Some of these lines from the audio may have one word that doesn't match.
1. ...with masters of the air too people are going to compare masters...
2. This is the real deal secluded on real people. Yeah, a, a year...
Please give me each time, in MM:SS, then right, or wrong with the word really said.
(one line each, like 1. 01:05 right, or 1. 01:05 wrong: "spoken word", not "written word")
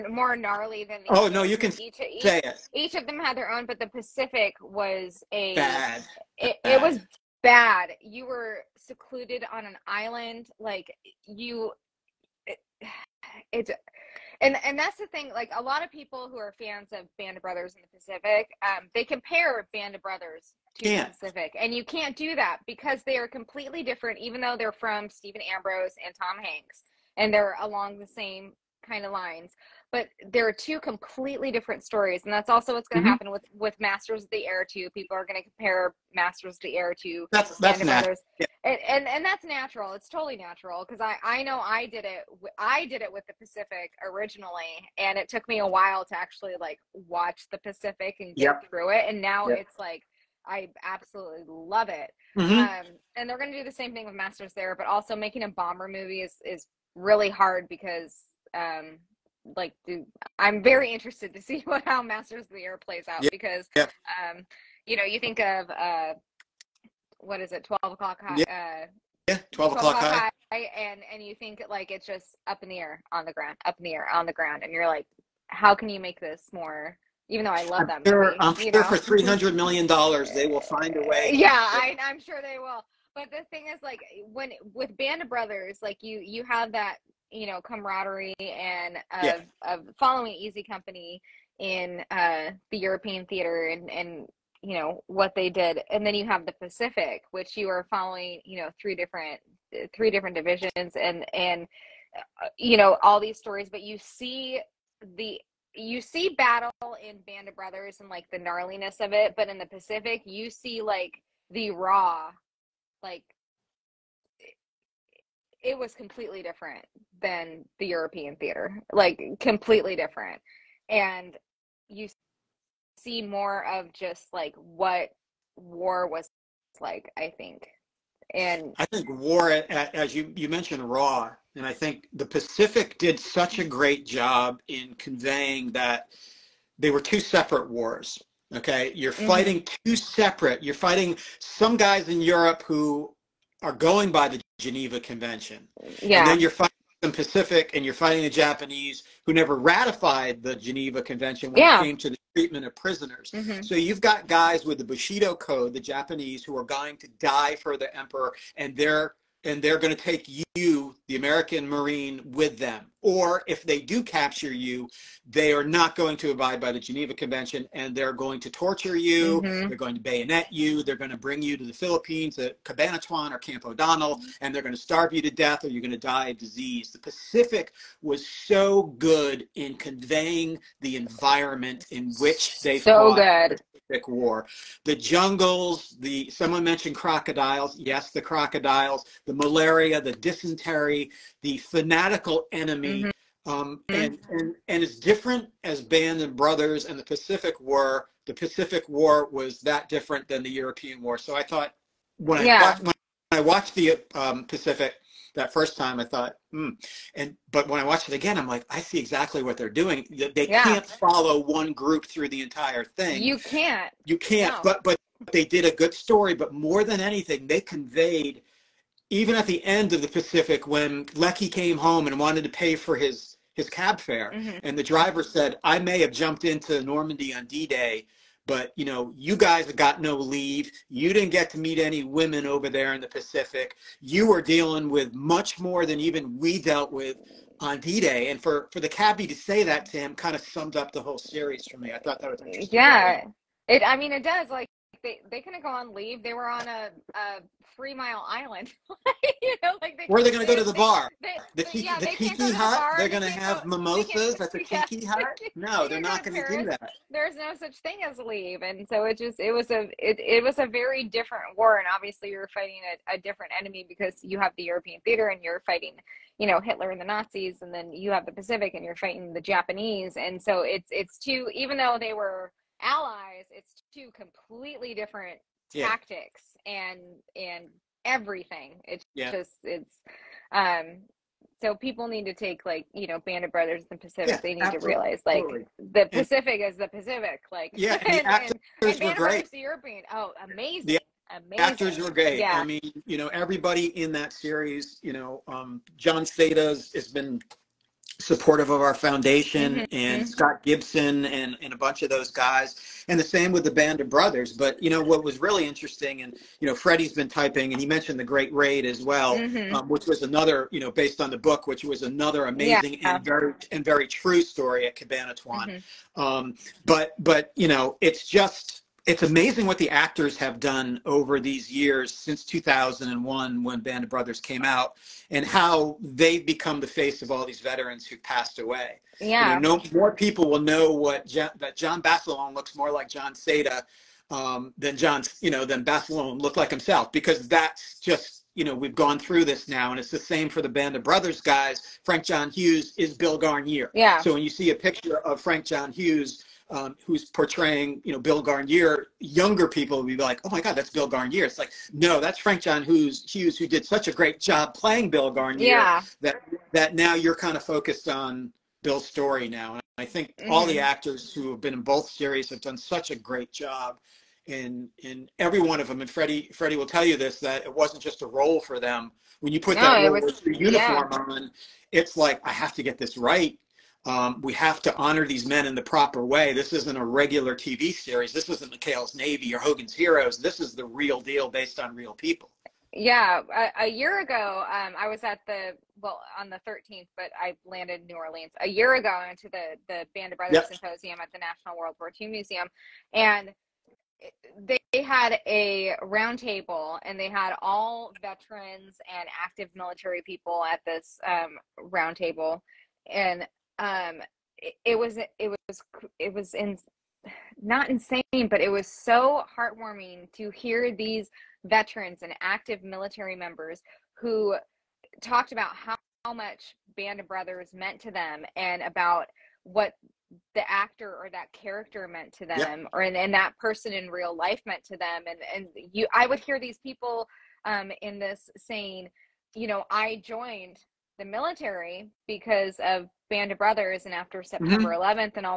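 1. 00:33 right
2. 06:20 wrong: "based", not "secluded".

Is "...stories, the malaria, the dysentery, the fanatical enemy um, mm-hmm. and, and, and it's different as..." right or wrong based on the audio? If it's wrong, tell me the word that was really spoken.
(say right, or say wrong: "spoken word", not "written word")
wrong: "crocodiles", not "stories".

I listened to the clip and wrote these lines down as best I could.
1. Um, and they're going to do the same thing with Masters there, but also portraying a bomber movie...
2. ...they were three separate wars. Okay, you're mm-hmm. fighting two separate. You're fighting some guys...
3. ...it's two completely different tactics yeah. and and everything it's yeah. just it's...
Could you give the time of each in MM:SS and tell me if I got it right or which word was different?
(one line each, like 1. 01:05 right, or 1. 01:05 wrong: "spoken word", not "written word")
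1. 00:52 wrong: "making", not "portraying"
2. 02:16 wrong: "two", not "three"
3. 04:33 right.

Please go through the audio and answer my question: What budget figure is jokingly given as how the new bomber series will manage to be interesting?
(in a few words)
300 million dollars.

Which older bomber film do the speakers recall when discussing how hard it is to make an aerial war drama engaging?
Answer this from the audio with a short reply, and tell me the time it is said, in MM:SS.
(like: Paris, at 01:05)
12 O'Clock High, at 01:07.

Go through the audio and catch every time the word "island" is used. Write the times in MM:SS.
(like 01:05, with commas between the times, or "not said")
00:09, 04:08.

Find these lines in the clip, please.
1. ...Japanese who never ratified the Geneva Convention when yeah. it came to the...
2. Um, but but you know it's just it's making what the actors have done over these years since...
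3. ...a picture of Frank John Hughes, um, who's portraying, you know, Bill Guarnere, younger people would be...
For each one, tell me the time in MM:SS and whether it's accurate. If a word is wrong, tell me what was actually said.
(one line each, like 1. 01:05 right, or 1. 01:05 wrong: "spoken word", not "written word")
1. 02:28 right
2. 05:16 wrong: "amazing", not "making"
3. 05:44 right.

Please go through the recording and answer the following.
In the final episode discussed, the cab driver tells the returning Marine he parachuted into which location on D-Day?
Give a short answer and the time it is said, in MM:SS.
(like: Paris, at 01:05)
Normandy, at 03:46.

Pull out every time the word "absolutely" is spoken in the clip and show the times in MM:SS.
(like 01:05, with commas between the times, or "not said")
00:50, 04:44.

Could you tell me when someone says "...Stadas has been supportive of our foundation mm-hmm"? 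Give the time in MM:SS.
04:56.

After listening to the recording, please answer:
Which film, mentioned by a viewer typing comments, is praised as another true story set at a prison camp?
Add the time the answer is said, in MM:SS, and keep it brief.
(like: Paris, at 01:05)
The Great Raid, at 05:08.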